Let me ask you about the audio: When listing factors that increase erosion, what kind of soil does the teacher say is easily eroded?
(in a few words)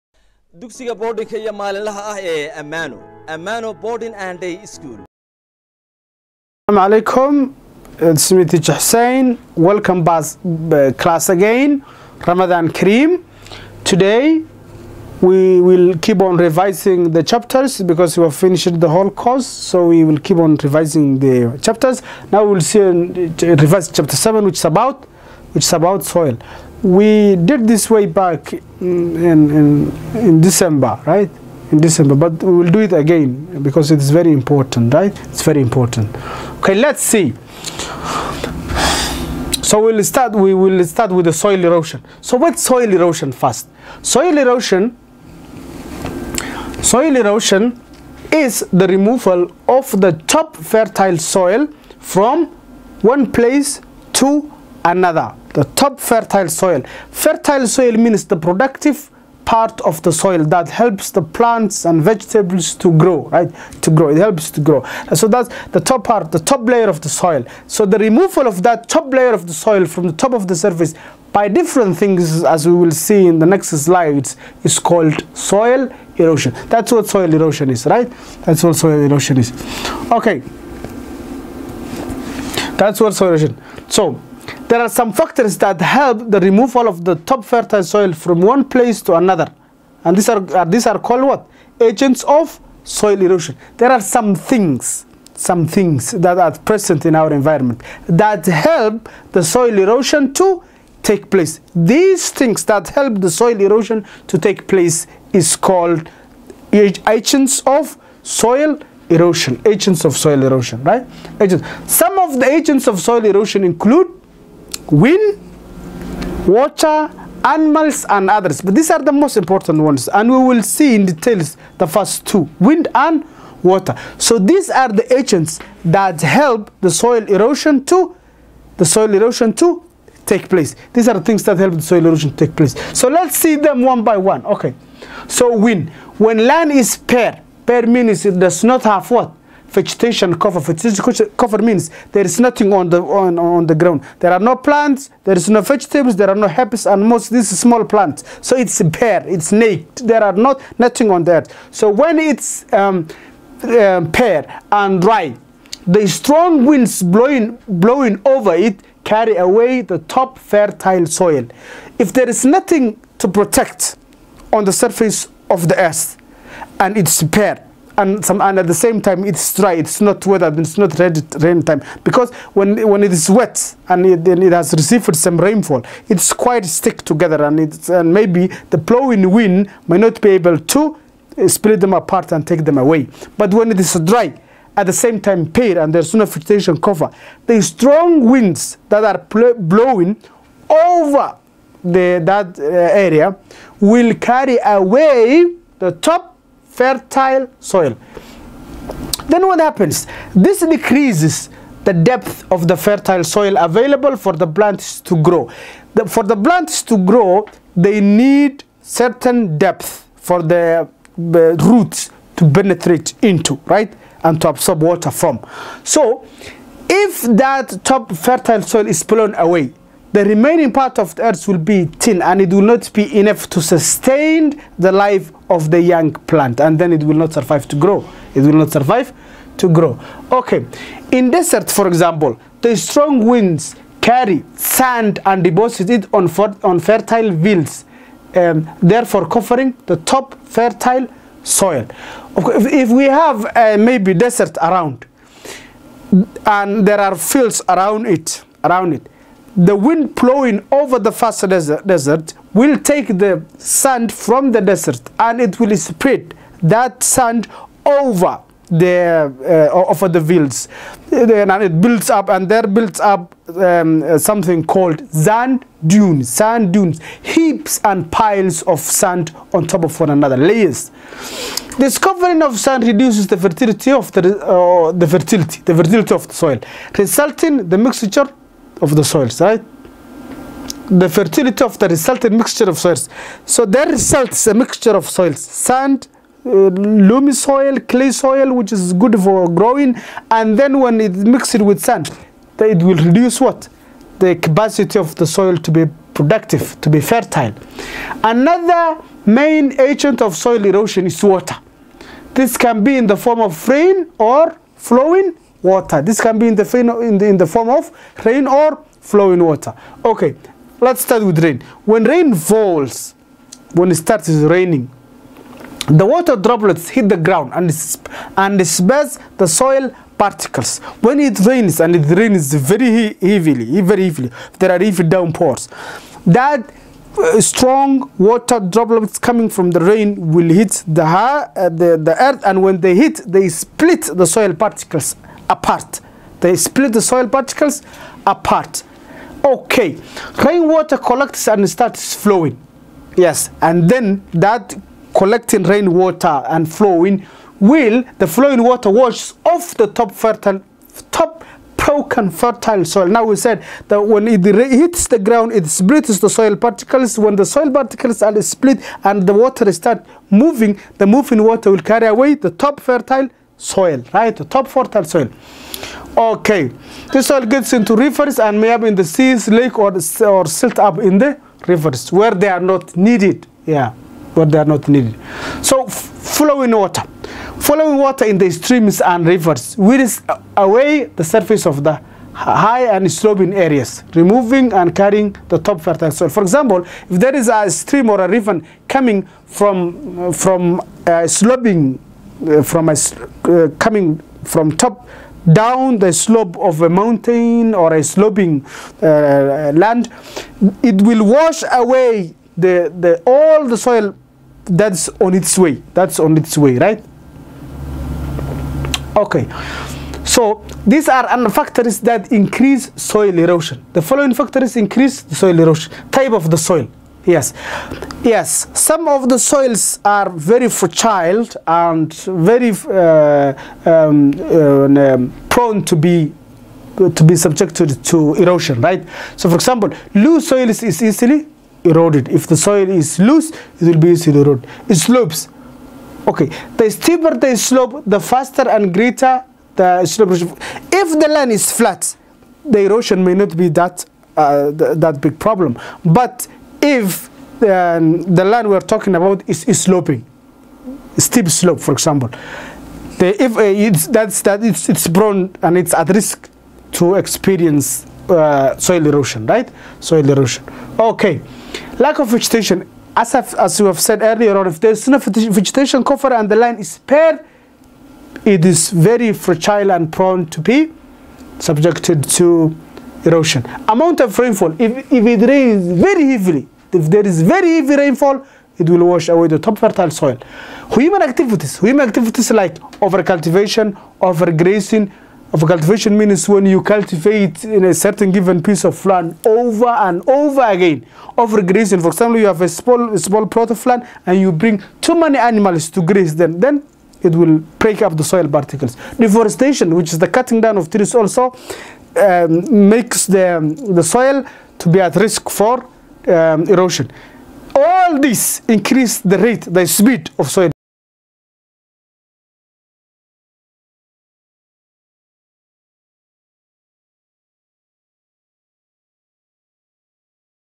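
Loose soil.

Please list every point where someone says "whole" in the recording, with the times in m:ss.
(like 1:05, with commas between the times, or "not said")
0:18.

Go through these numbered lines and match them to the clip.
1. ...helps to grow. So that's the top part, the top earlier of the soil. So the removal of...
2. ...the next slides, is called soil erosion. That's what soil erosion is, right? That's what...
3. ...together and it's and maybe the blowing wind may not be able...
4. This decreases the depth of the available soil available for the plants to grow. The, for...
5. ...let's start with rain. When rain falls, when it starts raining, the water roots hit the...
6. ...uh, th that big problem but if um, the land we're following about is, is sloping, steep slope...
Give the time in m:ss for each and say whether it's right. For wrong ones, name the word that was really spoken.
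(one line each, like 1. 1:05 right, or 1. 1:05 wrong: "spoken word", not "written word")
1. 1:04 wrong: "layer", not "earlier"
2. 1:13 right
3. 2:57 right
4. 3:20 wrong: "fertile", not "available"
5. 5:10 wrong: "droplets", not "roots"
6. 7:24 wrong: "talking", not "following".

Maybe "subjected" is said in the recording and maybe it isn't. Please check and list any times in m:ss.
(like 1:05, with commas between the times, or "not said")
7:07, 7:51.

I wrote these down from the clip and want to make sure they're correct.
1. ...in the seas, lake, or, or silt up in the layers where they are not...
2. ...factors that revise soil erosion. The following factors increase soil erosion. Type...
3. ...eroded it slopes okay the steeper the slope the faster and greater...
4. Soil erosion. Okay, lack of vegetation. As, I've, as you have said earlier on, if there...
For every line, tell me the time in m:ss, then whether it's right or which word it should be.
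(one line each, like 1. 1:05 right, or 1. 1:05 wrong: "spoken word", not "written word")
1. 6:08 wrong: "rivers", not "layers"
2. 6:51 wrong: "increase", not "revise"
3. 7:14 right
4. 7:39 right.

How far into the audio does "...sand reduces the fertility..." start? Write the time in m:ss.
4:32.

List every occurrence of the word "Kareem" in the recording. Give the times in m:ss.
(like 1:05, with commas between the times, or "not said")
0:12.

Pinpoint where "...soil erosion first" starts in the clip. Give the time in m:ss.
0:42.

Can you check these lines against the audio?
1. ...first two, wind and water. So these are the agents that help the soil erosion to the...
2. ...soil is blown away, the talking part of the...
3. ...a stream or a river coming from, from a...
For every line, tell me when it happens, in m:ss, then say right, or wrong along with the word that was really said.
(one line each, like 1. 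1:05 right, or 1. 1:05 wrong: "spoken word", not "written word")
1. 2:01 right
2. 3:38 wrong: "remaining", not "talking"
3. 6:27 right.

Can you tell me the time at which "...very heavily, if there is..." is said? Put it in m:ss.
7:55.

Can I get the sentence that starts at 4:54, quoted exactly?
The capacity of the soil to be productive, to be fertile.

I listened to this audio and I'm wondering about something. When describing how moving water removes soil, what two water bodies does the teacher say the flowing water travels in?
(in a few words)
Streams and rivers.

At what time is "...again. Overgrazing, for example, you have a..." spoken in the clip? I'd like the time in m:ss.
8:10.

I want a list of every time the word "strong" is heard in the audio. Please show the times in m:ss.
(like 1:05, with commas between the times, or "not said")
2:36, 3:07, 3:52, 5:27.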